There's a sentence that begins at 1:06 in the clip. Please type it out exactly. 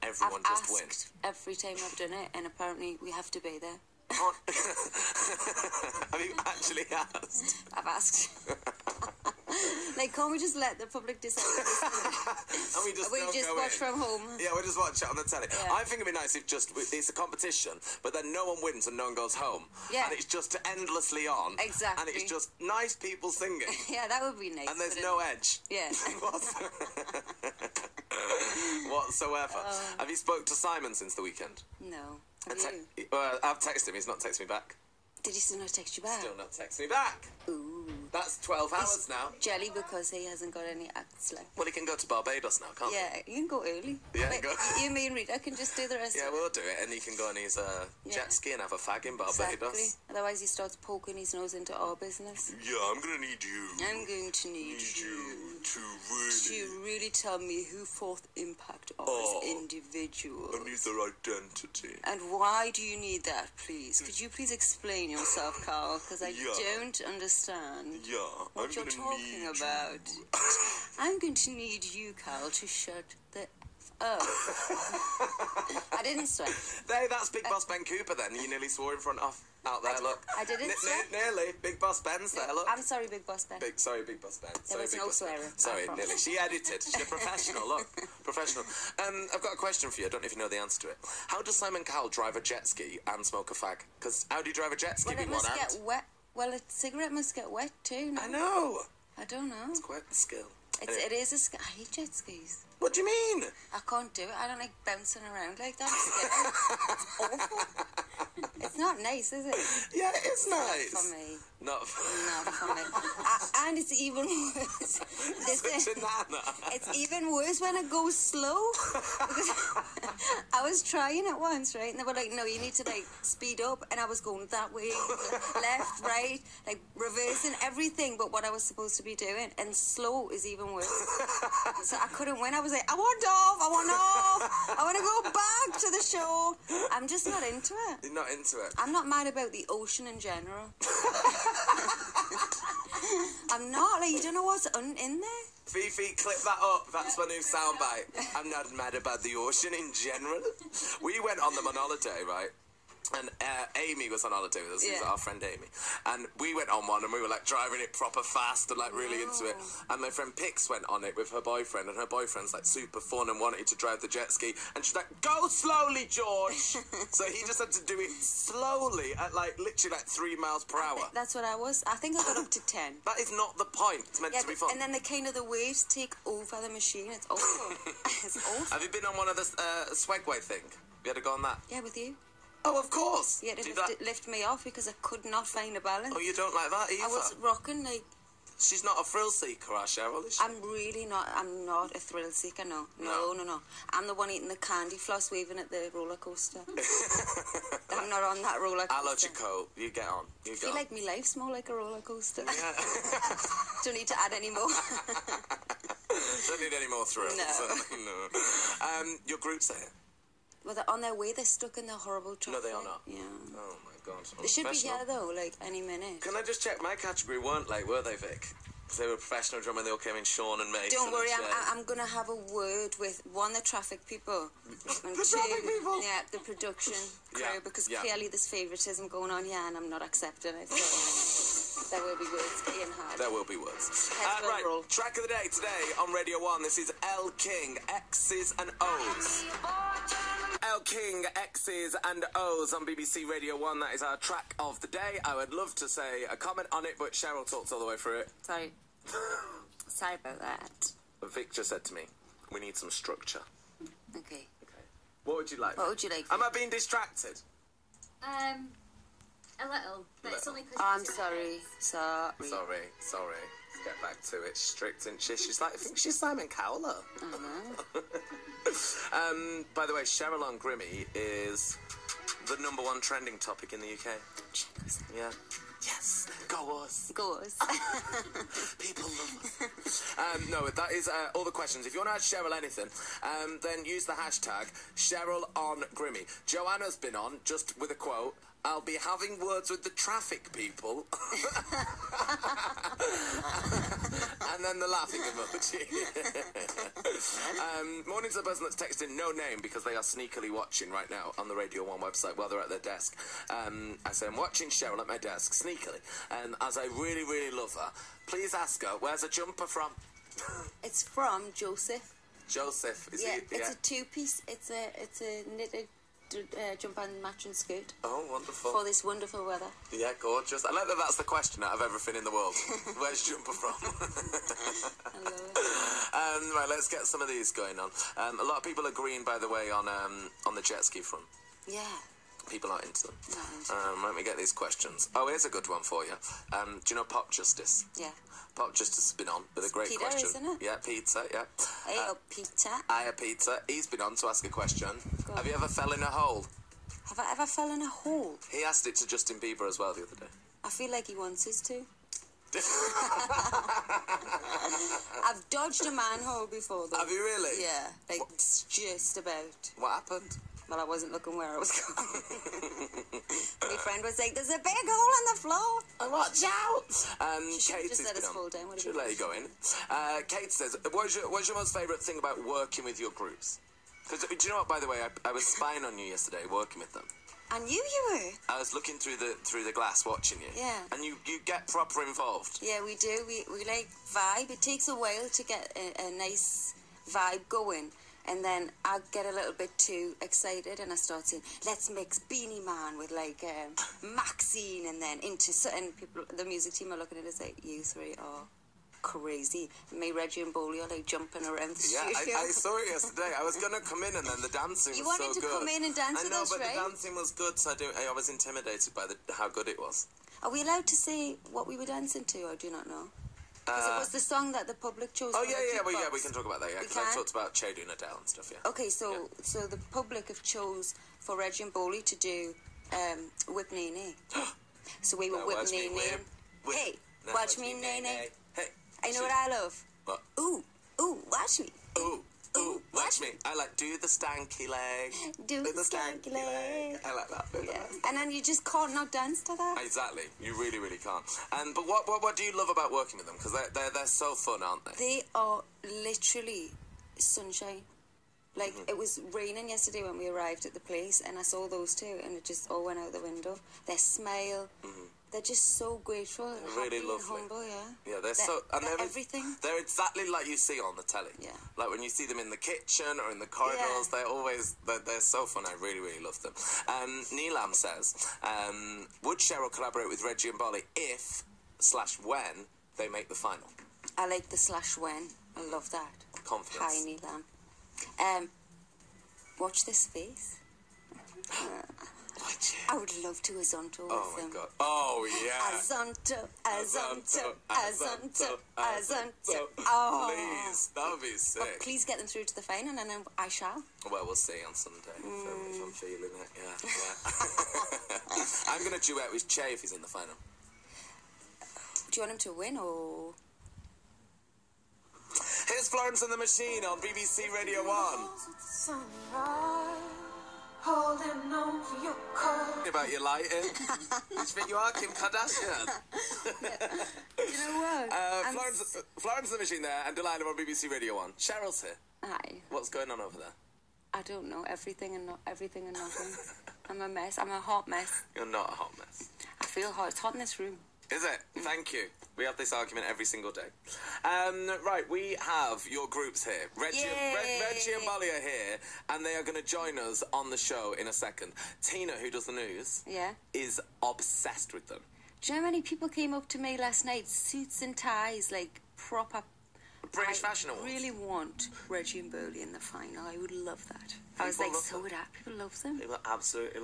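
don't understand yeah, what I'm you're talking about.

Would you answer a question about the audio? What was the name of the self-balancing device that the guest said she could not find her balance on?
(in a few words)
Swagway.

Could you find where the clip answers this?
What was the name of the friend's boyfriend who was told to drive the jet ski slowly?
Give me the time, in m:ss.
2:46.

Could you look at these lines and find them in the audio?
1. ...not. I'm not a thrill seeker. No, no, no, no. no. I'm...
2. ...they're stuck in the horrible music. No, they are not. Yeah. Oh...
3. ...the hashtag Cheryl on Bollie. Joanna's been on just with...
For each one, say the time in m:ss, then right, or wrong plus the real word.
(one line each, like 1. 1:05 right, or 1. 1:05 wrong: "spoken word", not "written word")
1. 3:11 right
2. 3:31 wrong: "traffic", not "music"
3. 4:44 wrong: "Grimmy", not "Bollie".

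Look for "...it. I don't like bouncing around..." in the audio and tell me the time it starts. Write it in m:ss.
1:44.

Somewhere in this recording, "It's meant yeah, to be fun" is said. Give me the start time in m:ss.
2:54.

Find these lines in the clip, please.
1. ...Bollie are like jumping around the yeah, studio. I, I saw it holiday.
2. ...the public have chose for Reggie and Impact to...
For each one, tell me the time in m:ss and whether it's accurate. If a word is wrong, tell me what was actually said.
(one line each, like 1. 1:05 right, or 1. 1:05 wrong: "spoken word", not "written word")
1. 6:40 wrong: "yesterday", not "holiday"
2. 6:59 wrong: "Bollie", not "Impact".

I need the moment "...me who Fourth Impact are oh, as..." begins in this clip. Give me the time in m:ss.
0:57.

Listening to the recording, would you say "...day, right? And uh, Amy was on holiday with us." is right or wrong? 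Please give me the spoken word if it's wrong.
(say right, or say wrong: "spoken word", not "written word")
right.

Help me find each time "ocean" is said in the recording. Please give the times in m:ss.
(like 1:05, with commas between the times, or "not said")
2:19, 2:29.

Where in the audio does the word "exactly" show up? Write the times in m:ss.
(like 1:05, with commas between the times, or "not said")
0:21, 0:49, 7:19, 7:39.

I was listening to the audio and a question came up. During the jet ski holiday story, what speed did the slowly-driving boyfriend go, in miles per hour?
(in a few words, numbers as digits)
3.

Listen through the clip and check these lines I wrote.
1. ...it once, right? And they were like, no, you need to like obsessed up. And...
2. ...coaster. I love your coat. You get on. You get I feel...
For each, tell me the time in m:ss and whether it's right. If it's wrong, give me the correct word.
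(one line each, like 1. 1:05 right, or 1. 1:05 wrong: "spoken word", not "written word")
1. 2:01 wrong: "speed", not "obsessed"
2. 3:18 right.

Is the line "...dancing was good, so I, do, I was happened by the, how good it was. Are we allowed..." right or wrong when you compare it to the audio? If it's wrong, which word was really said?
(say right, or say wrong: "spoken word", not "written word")
wrong: "intimidated", not "happened".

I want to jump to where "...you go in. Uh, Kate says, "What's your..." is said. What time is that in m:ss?
6:09.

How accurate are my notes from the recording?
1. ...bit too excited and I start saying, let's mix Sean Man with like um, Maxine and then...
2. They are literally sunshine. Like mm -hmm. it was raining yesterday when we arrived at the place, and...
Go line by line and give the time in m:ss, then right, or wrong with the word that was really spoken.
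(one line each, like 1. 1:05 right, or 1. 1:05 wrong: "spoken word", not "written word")
1. 6:29 wrong: "Beenie", not "Sean"
2. 7:24 right.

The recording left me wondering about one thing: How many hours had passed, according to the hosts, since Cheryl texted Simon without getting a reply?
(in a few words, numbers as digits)
12.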